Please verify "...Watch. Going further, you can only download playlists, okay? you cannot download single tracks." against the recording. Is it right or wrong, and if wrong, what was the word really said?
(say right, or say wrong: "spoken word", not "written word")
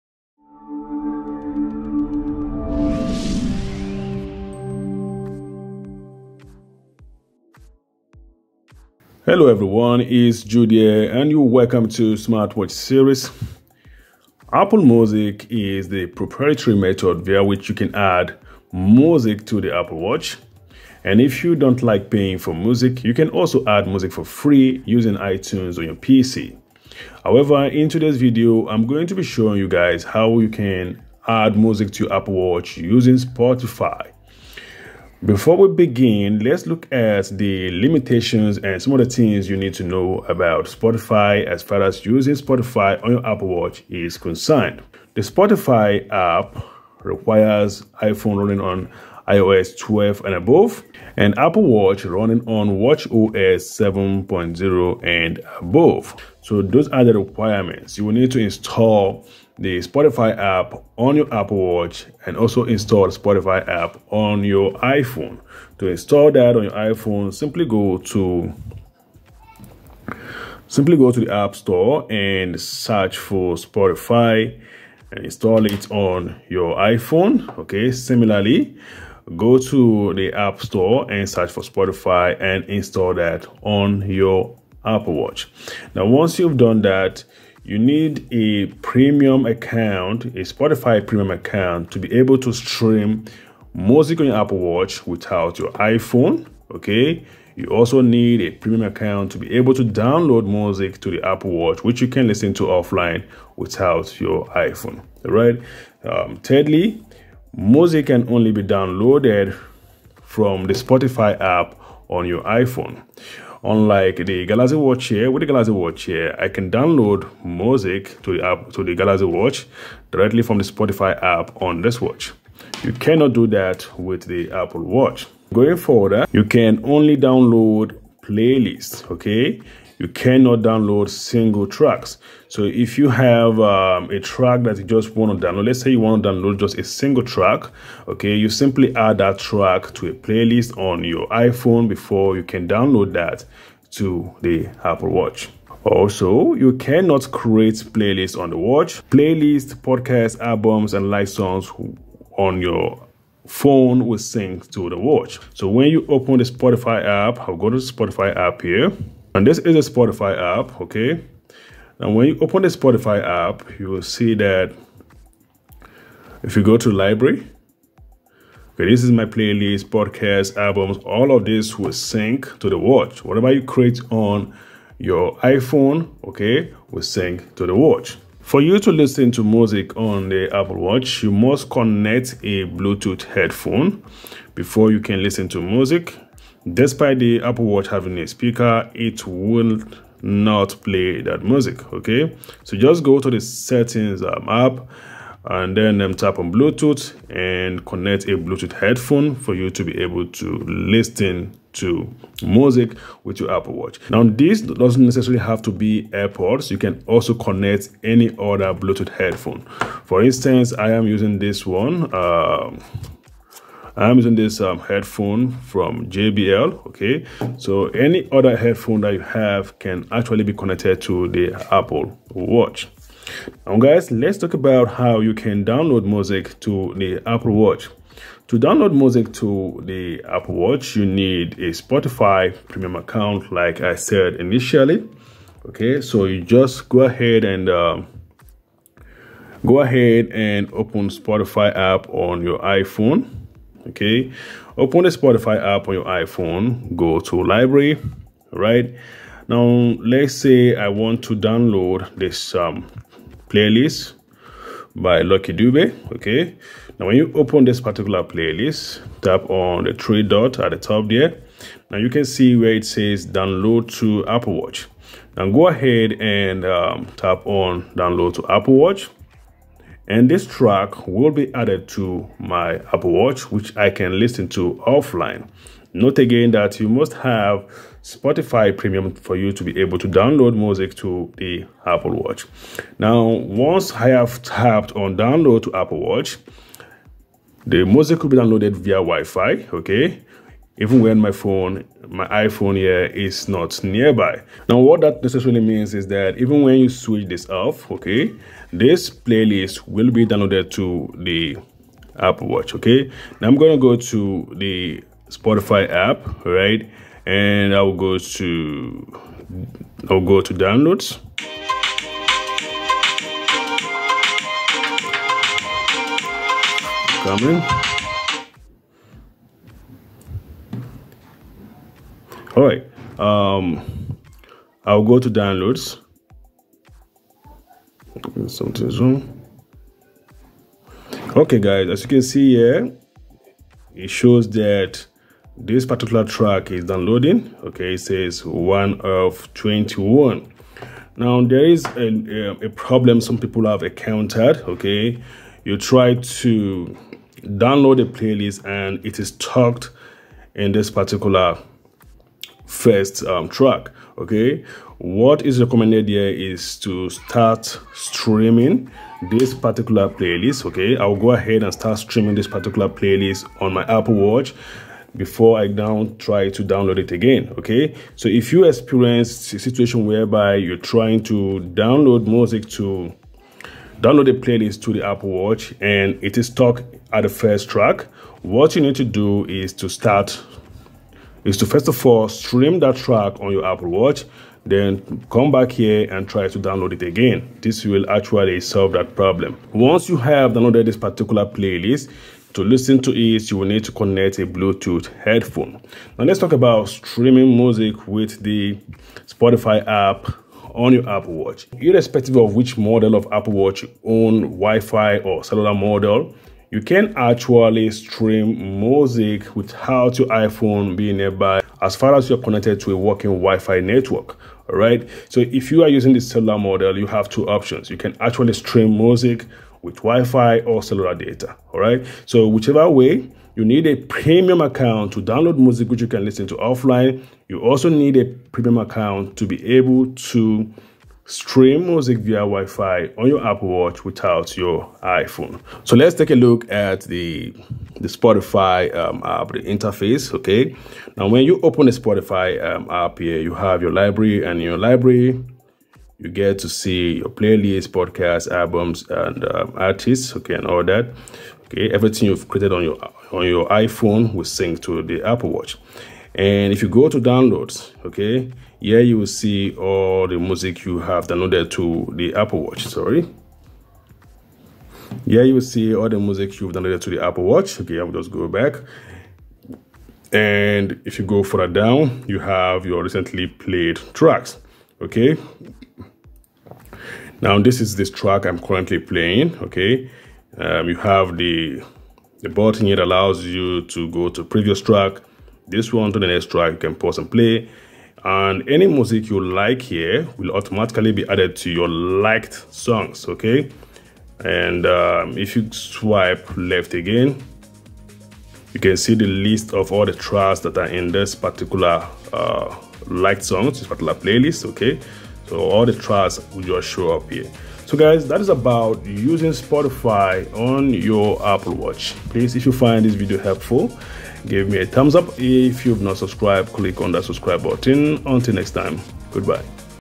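right.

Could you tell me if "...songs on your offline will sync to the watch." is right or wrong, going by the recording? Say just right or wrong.
wrong.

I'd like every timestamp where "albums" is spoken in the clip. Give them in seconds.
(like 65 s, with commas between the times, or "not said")
150 s, 170 s, 448 s.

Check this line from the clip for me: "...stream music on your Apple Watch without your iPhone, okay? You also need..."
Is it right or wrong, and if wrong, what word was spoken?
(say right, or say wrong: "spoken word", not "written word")
right.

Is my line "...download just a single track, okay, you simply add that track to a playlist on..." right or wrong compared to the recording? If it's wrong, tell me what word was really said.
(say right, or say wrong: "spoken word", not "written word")
right.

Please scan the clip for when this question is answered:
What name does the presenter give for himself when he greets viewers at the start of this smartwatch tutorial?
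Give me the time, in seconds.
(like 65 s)
10 s.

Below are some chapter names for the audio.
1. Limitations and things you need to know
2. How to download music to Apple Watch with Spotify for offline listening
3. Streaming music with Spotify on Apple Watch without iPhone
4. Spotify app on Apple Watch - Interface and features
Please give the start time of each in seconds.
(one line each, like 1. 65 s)
1. 45 s
2. 227 s
3. 403 s
4. 436 s.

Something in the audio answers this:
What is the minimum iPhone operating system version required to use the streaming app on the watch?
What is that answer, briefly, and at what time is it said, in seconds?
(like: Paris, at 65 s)
iOS 12, at 49 s.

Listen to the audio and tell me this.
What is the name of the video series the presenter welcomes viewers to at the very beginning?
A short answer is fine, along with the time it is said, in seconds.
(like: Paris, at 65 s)
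Smartwatch series, at 12 s.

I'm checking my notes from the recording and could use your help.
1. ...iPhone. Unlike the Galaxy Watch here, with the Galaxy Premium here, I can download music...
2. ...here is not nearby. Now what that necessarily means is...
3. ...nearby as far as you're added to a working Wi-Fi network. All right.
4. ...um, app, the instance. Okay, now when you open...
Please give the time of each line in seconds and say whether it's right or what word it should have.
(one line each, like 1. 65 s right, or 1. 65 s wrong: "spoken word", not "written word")
1. 112 s wrong: "Watch", not "Premium"
2. 292 s right
3. 411 s wrong: "connected", not "added"
4. 438 s wrong: "interface", not "instance".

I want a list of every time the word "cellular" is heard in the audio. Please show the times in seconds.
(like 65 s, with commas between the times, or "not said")
405 s, 416 s, 420 s.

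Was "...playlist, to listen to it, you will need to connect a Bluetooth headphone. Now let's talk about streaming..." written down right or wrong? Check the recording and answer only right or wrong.
right.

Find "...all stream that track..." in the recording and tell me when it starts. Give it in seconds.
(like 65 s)
382 s.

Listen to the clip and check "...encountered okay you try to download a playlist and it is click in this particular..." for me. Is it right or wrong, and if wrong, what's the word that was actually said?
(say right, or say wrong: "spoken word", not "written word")
wrong: "stuck", not "click".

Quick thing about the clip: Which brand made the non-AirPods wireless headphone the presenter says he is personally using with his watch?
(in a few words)
JBL.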